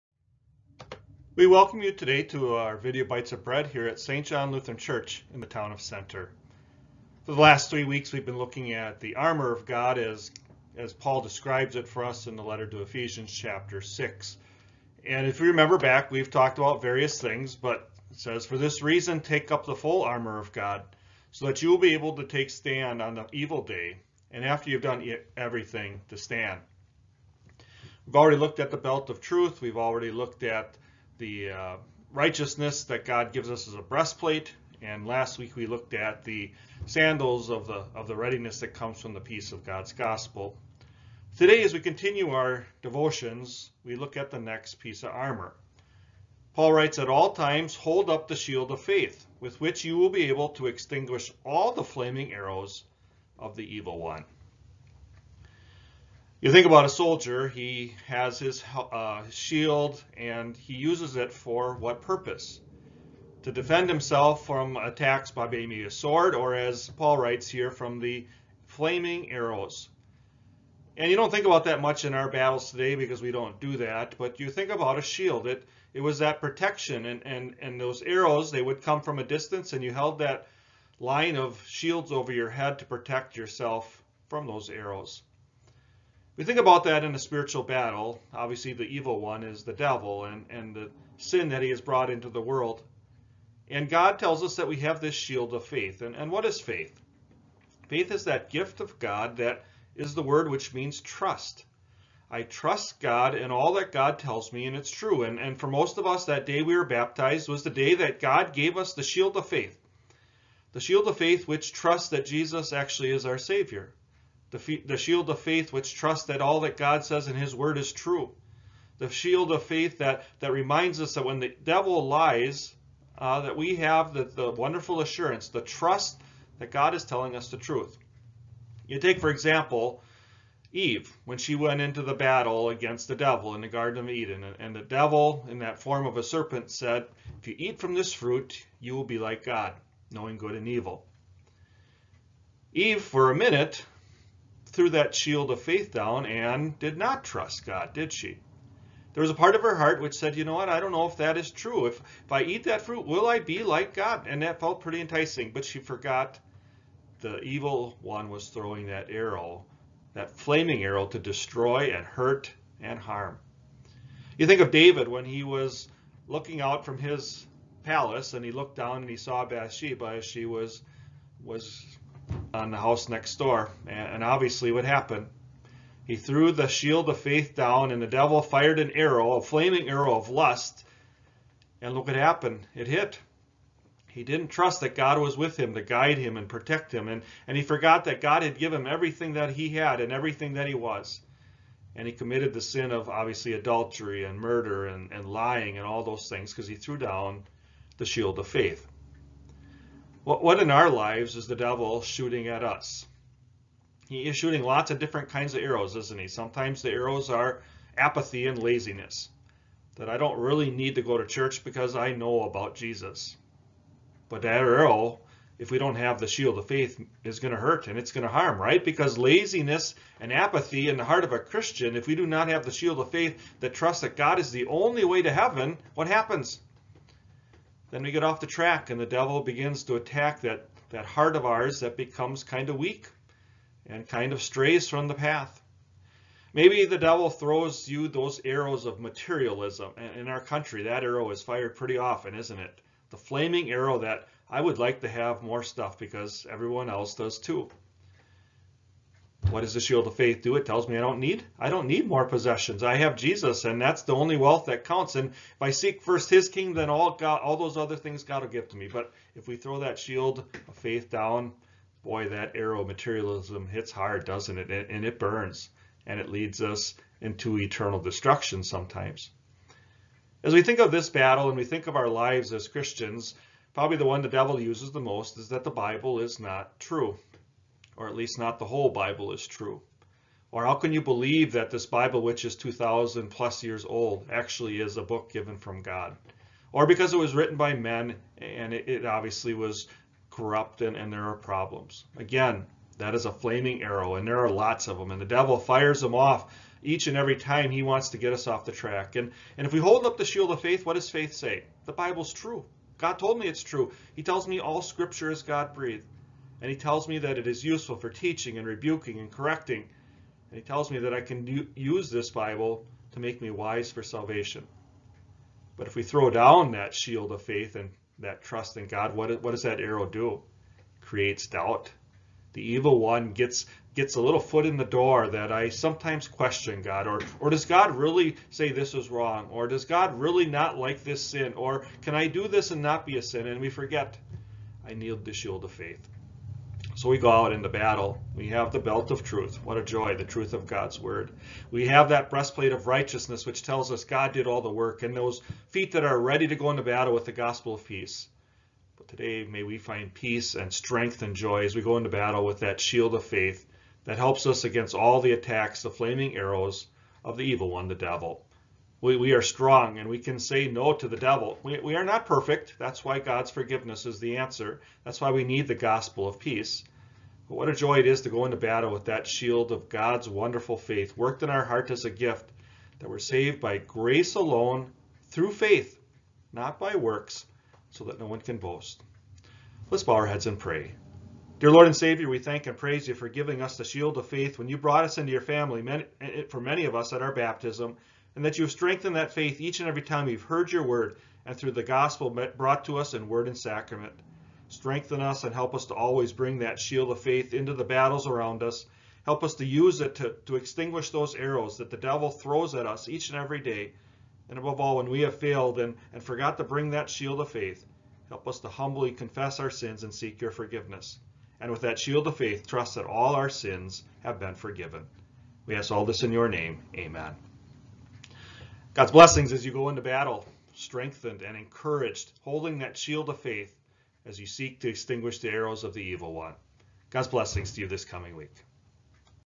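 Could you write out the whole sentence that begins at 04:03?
The flaming arrow that I would like to have more stuff because everyone else does too.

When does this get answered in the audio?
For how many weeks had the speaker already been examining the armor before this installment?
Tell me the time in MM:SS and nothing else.
00:07.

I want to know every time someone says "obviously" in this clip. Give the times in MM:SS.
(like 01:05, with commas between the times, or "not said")
01:28, 02:54, 03:13, 04:49.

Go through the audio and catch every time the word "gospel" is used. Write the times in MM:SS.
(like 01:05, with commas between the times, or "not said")
00:39, 05:47, 06:05, 06:31.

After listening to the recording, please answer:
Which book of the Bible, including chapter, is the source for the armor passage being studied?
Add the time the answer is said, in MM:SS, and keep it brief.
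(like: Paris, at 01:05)
Ephesians chapter 6, at 00:12.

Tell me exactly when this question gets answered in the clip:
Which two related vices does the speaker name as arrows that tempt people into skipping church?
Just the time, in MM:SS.
03:27.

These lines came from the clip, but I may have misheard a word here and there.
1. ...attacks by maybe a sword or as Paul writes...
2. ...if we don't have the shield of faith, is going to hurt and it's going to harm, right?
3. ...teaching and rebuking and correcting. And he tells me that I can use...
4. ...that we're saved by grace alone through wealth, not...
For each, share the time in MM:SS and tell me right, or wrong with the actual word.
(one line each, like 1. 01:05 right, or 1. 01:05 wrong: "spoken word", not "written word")
1. 01:04 right
2. 03:35 right
3. 05:08 right
4. 06:12 wrong: "faith", not "wealth".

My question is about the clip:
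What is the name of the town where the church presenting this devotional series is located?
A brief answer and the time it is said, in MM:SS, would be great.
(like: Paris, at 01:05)
Center, at 00:05.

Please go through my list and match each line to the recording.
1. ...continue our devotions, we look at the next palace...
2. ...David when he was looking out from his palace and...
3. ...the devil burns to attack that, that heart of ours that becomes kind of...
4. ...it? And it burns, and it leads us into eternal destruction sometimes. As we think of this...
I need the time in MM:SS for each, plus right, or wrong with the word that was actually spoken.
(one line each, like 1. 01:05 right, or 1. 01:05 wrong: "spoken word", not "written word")
1. 00:41 wrong: "piece", not "palace"
2. 02:44 right
3. 03:48 wrong: "begins", not "burns"
4. 04:24 right.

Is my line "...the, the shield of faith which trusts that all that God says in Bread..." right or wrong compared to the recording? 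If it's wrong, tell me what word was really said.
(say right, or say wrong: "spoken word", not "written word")
wrong: "His", not "Bread".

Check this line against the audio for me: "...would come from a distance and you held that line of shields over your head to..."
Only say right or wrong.
right.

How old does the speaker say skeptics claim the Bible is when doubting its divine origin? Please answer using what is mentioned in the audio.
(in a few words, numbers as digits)
2,000 plus years.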